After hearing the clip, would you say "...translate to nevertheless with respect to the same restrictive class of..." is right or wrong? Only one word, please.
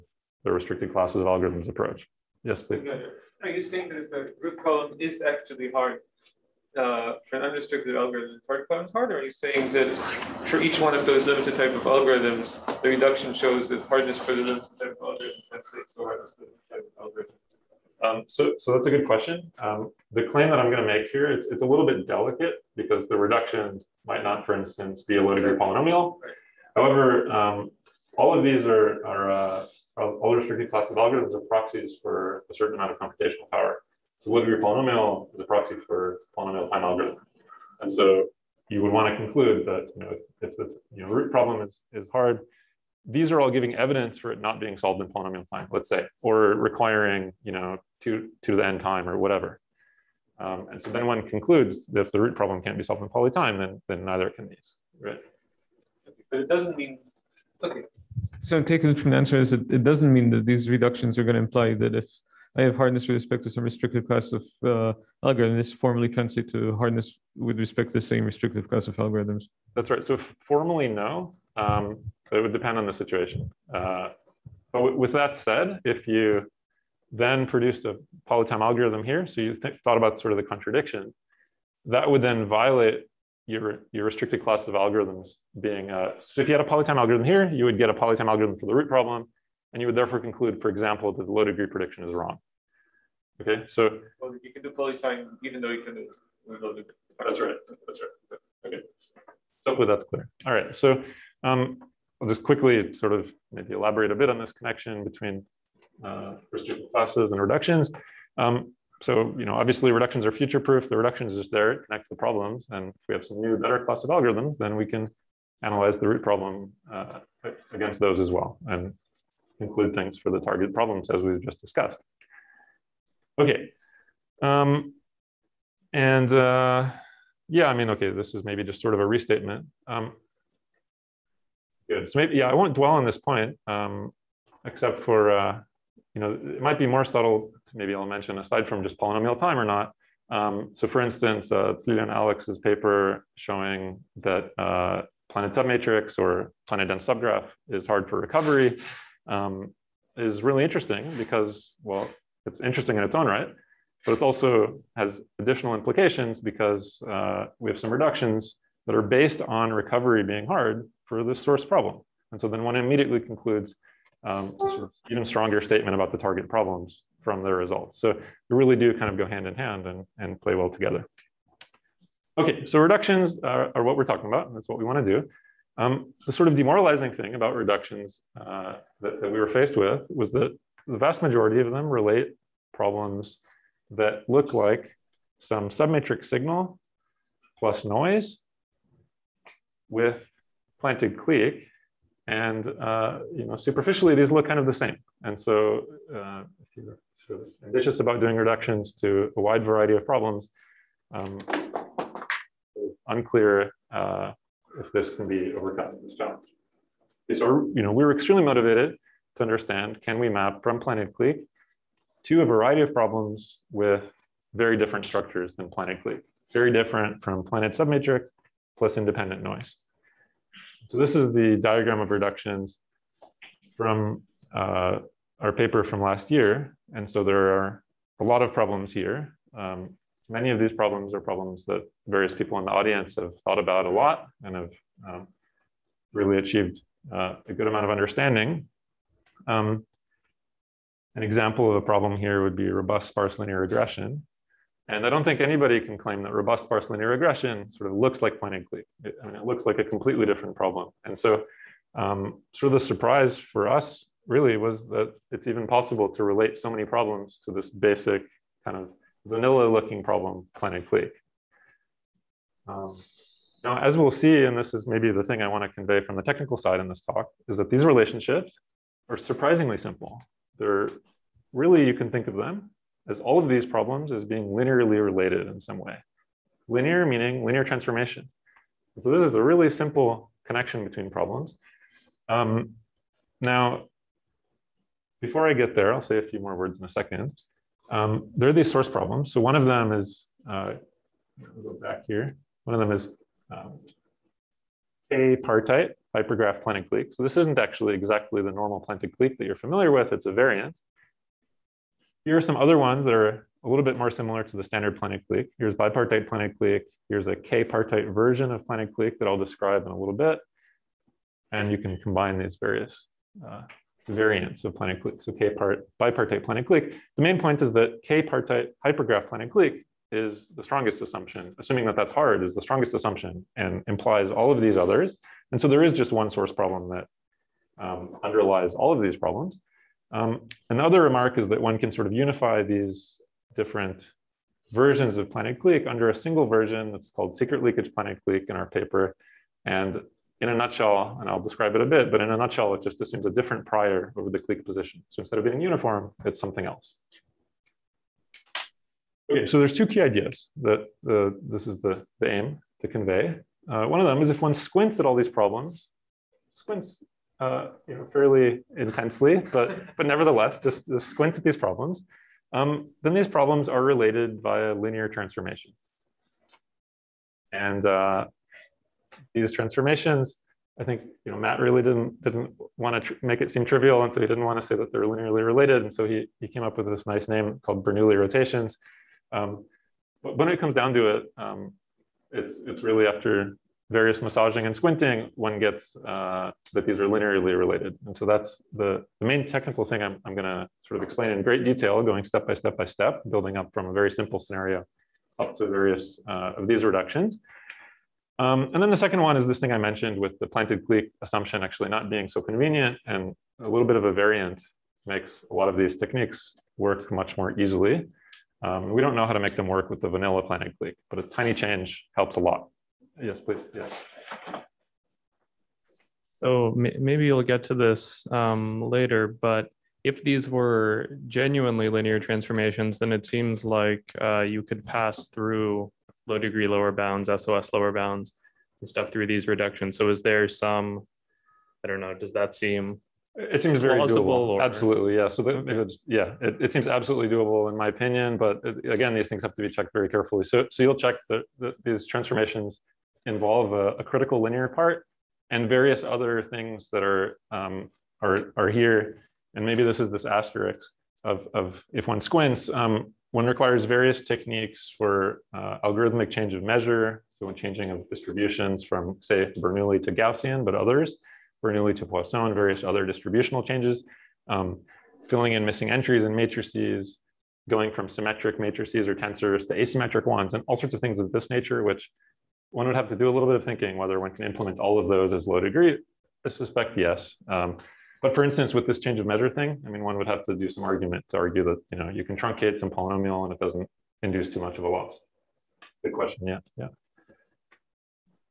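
wrong.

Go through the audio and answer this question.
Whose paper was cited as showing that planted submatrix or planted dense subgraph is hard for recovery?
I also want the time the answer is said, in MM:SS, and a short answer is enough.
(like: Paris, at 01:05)
Tzlila and Alex, at 02:21.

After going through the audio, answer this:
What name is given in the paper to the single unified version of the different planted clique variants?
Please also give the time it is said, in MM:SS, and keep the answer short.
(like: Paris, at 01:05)
secret leakage planted clique, at 05:37.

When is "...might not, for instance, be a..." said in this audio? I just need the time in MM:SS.
00:24.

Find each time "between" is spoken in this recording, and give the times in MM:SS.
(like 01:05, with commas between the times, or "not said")
01:45, 04:40.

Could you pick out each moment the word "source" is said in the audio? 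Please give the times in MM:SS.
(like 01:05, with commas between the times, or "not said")
02:41, 04:48, 05:26.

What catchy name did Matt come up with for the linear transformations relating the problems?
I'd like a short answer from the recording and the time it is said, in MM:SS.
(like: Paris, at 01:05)
Bernoulli rotations, at 06:17.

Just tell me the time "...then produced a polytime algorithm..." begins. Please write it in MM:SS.
01:17.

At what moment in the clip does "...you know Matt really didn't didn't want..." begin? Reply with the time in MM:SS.
06:11.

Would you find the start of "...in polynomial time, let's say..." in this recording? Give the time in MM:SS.
00:44.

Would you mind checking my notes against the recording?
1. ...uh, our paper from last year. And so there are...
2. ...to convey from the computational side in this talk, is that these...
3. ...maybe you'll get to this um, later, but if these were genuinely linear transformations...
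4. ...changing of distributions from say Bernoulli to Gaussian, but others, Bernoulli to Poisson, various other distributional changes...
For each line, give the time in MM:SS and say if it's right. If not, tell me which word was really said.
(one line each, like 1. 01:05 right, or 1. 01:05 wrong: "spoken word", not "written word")
1. 03:44 right
2. 04:25 wrong: "technical", not "computational"
3. 06:56 right
4. 07:37 right.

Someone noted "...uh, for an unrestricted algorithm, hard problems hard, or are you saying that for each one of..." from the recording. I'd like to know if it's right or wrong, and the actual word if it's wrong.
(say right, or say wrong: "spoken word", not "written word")
right.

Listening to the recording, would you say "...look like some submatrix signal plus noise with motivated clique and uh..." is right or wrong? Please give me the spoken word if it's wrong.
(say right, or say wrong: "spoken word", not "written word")
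wrong: "planted", not "motivated".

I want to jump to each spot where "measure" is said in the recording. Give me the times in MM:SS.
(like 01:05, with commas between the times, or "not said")
07:36, 07:59.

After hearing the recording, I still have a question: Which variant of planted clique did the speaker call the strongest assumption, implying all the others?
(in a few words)
k-partite hypergraph planted clique.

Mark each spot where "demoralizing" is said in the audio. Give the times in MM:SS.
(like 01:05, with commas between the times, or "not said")
02:56.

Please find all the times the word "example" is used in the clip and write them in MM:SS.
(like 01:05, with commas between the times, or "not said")
01:30, 04:01.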